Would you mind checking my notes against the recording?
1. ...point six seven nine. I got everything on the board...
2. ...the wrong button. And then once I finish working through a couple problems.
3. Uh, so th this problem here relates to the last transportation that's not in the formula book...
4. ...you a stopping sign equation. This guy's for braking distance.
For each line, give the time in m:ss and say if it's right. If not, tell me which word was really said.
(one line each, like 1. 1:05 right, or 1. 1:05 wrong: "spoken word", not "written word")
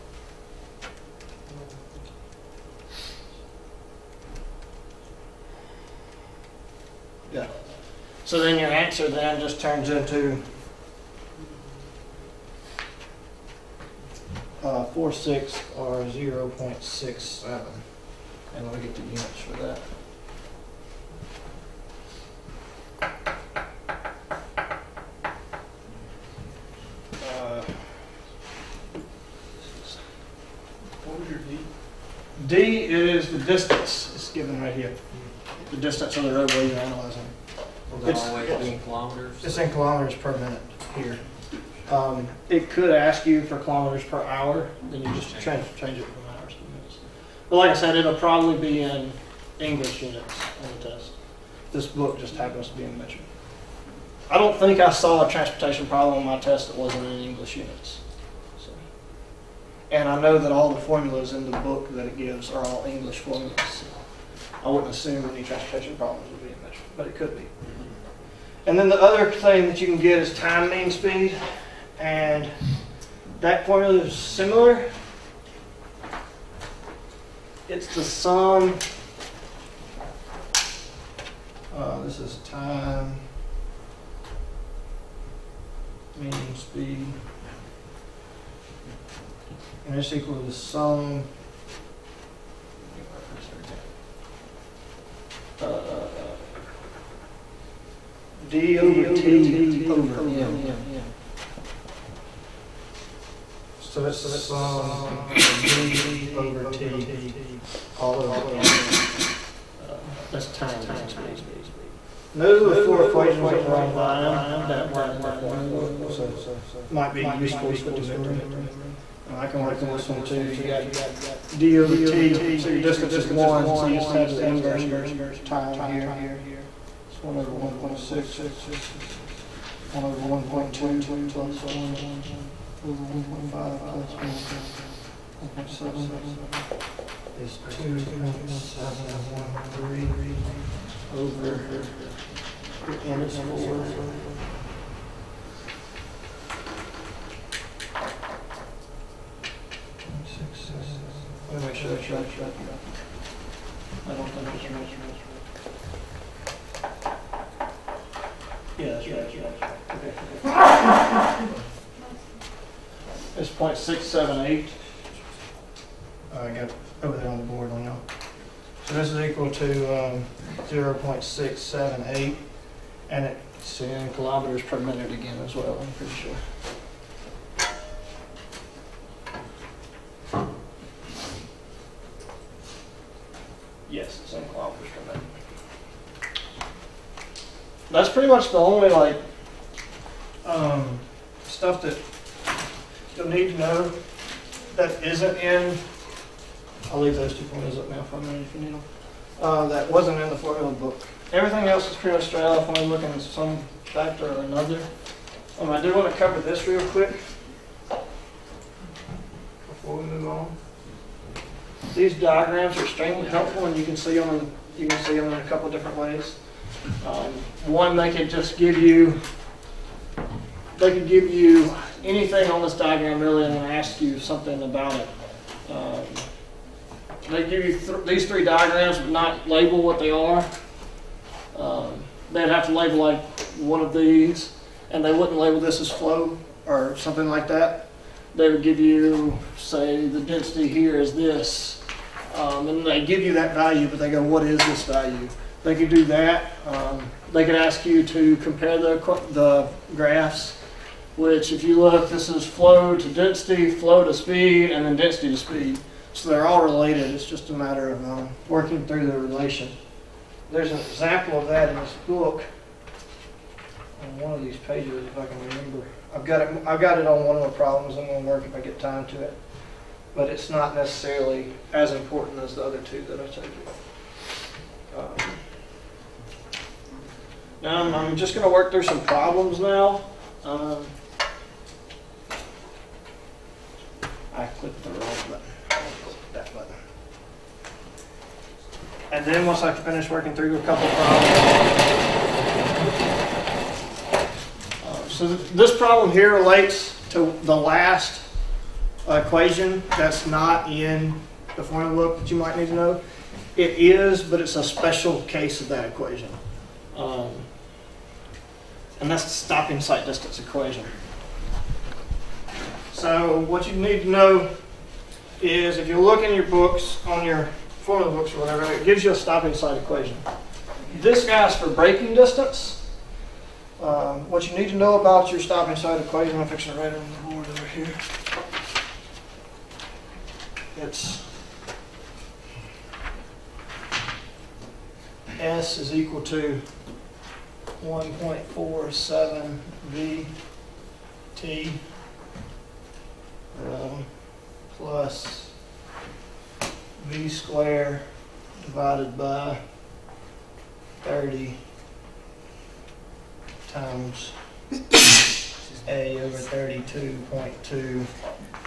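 1. 2:43 wrong: "eight", not "nine"
2. 4:44 right
3. 4:54 wrong: "equation", not "transportation"
4. 5:19 right.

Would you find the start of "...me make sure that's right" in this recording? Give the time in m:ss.
2:31.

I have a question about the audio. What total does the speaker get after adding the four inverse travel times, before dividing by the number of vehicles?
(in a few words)
2.713.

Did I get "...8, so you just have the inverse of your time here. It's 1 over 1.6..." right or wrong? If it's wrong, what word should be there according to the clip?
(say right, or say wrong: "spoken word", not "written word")
wrong: "1", not "8".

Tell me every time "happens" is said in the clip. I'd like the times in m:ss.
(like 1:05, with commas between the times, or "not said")
0:52.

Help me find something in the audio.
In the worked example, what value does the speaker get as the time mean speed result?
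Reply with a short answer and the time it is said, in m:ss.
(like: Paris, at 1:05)
0.678, at 2:50.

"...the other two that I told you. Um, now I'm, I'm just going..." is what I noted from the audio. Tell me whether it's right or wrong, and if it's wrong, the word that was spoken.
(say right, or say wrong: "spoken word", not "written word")
right.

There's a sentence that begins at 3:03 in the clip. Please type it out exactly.
Yes, it's in kilometers per minute.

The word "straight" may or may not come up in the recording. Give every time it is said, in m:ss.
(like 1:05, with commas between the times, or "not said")
3:22.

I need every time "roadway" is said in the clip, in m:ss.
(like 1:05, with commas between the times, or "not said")
0:36.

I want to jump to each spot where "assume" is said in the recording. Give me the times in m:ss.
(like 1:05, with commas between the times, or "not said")
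1:04.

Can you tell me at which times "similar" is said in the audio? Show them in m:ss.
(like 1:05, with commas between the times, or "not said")
1:14.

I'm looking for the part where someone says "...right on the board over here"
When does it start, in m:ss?
5:26.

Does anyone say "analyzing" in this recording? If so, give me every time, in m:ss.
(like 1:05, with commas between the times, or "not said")
0:36.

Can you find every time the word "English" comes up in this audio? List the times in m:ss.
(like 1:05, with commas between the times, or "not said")
0:49, 0:57, 1:02.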